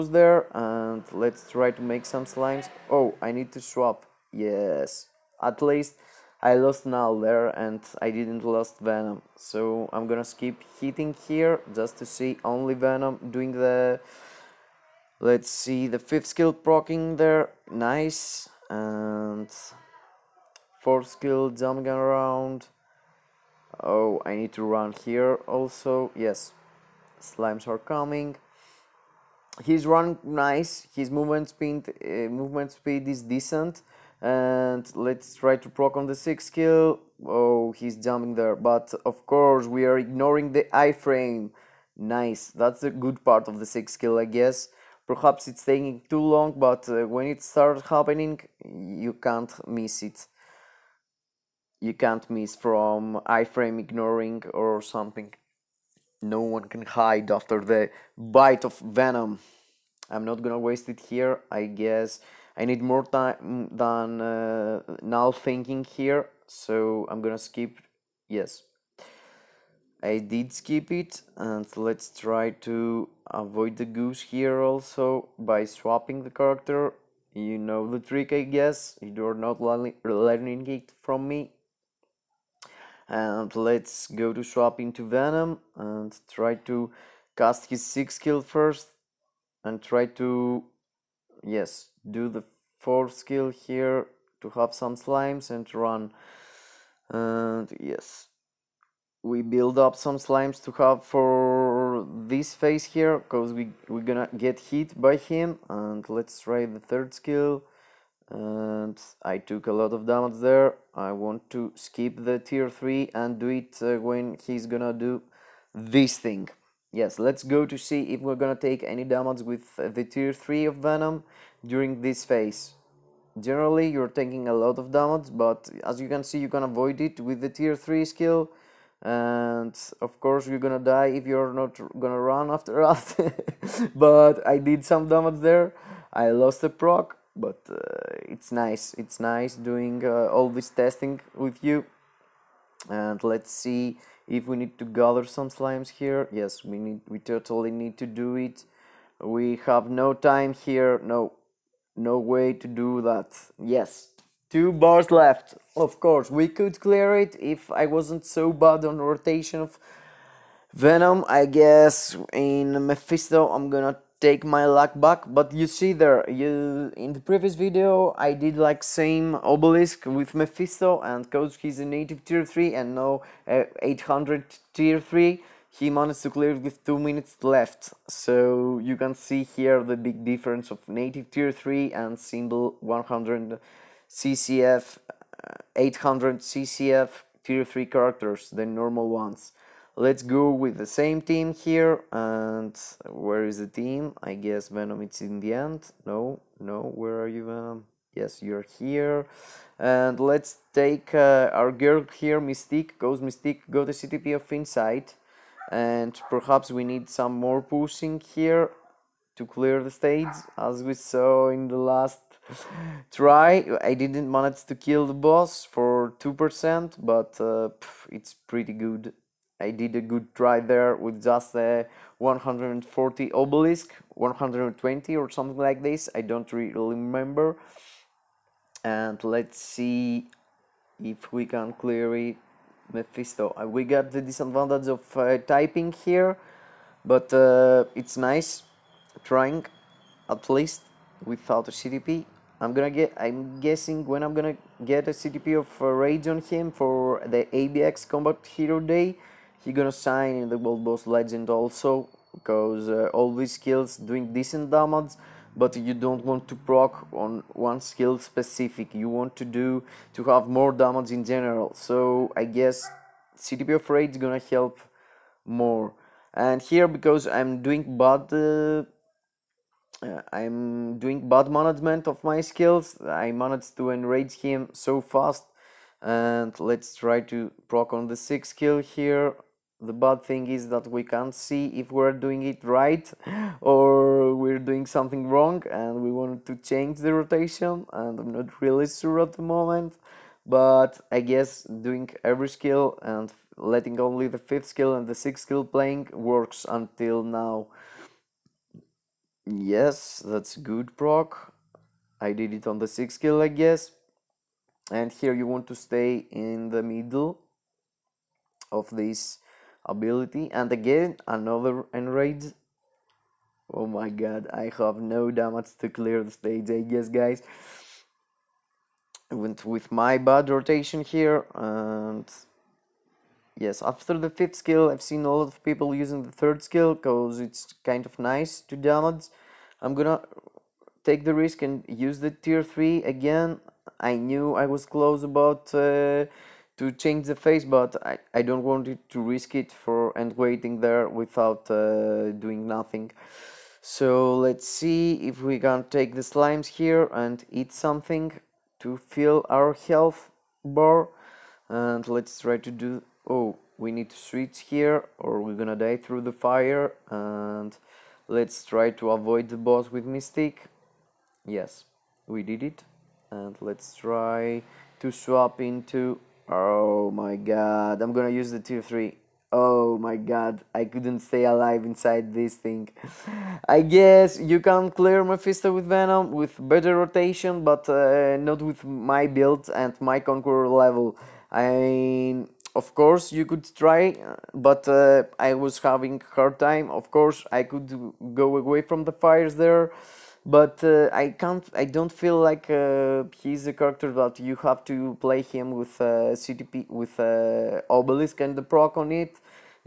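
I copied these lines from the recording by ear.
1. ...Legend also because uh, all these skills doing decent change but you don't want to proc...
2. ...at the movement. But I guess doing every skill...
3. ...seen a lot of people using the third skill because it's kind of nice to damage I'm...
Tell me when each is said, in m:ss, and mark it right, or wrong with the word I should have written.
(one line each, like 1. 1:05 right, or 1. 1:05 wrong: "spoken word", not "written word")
1. 4:11 wrong: "damage", not "change"
2. 4:49 wrong: "moment", not "movement"
3. 5:25 right.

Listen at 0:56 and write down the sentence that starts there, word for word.
No one can hide after the bite of Venom.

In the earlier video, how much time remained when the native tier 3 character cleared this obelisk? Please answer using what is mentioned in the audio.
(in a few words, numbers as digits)
2 minutes.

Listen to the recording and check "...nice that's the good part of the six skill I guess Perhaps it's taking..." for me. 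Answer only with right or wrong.
right.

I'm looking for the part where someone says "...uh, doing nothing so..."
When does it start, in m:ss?
5:41.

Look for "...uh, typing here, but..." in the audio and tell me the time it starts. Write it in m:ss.
3:55.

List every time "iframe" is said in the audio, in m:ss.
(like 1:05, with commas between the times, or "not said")
0:40, 0:53.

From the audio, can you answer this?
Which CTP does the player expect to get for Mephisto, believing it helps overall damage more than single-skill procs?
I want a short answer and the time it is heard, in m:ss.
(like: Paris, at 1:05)
CTP of Rage, at 4:23.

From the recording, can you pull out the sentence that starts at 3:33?
I didn't manage to kill the boss for 2%, but uh, it's pretty good.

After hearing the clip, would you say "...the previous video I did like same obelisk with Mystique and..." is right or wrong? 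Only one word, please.
wrong.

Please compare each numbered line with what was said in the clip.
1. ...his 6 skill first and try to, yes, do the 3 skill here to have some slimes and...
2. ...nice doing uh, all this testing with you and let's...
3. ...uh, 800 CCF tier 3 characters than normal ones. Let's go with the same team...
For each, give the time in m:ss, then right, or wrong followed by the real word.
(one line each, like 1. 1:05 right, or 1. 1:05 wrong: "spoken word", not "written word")
1. 1:27 wrong: "4", not "3"
2. 2:19 right
3. 3:05 right.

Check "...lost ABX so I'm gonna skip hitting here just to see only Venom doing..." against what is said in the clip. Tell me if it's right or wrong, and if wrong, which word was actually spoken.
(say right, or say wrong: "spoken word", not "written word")
wrong: "Venom", not "ABX".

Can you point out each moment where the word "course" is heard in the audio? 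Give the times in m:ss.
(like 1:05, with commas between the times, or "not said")
0:39, 2:10, 2:36, 6:22, 6:27.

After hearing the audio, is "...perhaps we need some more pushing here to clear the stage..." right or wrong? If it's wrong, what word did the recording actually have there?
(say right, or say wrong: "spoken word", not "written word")
right.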